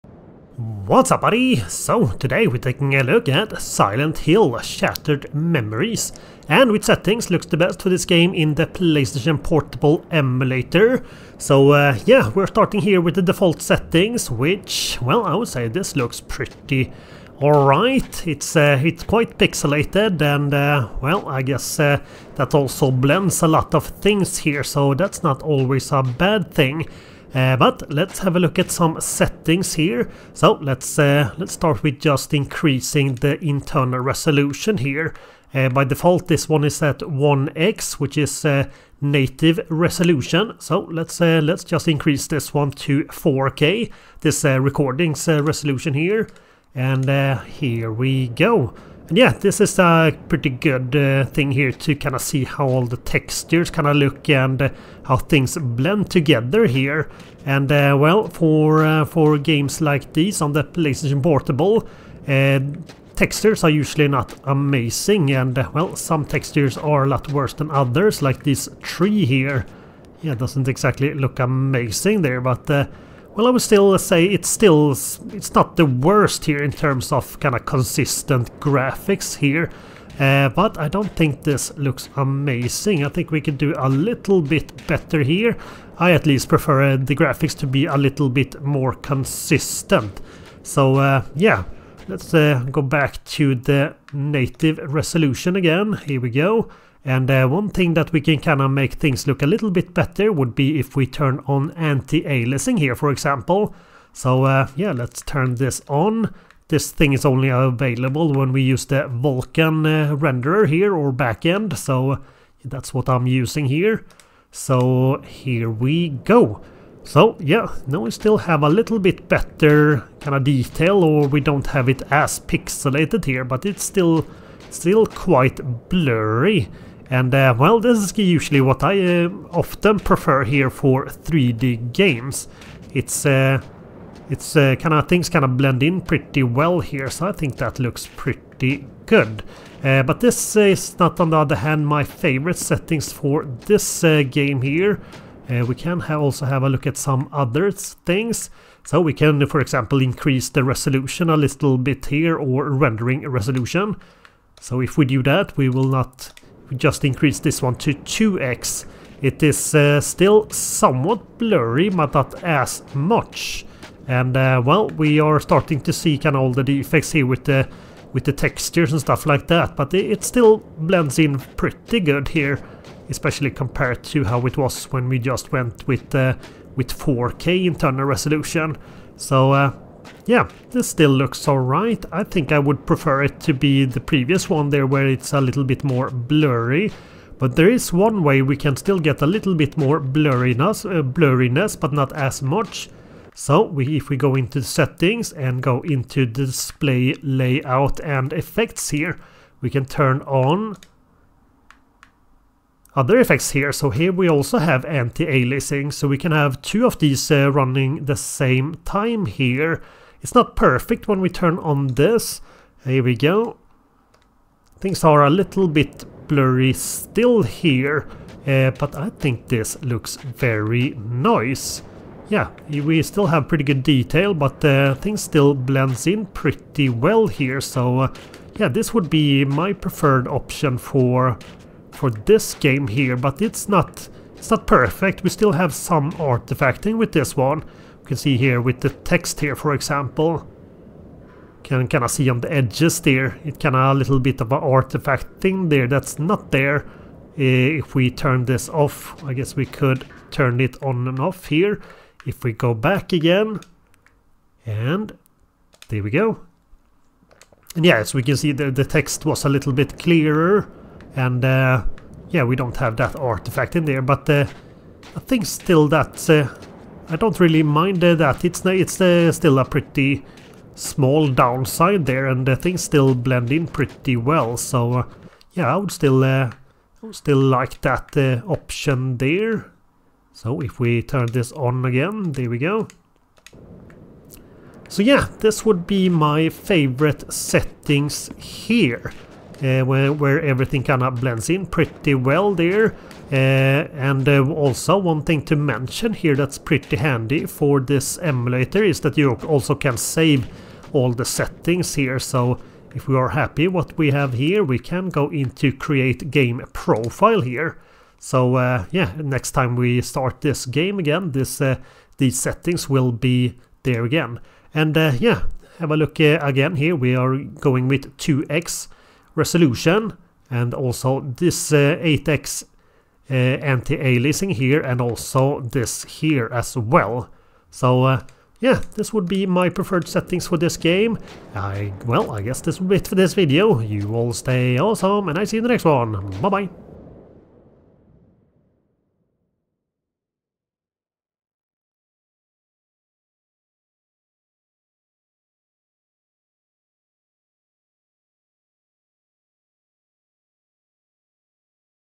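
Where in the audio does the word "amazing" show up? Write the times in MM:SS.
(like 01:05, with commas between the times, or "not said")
01:04, 01:11, 01:22.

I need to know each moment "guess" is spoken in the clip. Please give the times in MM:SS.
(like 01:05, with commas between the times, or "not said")
00:21, 04:09, 05:32.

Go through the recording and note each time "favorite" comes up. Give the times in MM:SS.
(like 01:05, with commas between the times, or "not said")
02:22, 04:46.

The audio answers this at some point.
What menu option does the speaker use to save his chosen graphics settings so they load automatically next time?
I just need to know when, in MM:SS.
05:05.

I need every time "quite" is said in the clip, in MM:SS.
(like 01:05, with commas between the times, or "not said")
00:19, 02:05.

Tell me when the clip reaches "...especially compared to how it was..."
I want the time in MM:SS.
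02:53.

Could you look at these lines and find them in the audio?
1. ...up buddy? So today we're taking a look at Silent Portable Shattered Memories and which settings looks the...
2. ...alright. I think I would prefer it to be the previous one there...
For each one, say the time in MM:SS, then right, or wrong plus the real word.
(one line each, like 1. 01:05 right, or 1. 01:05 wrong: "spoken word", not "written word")
1. 00:01 wrong: "Hill", not "Portable"
2. 03:01 right.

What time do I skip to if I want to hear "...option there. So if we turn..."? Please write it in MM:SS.
04:38.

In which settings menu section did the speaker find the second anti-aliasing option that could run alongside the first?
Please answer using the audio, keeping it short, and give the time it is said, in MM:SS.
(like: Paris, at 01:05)
Display layout and effects, at 03:16.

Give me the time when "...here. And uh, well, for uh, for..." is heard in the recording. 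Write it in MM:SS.
00:56.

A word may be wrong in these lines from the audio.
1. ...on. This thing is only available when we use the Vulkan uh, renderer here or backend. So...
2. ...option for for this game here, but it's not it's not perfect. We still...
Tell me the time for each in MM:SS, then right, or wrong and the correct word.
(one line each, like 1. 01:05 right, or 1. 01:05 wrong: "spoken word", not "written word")
1. 01:45 right
2. 03:50 right.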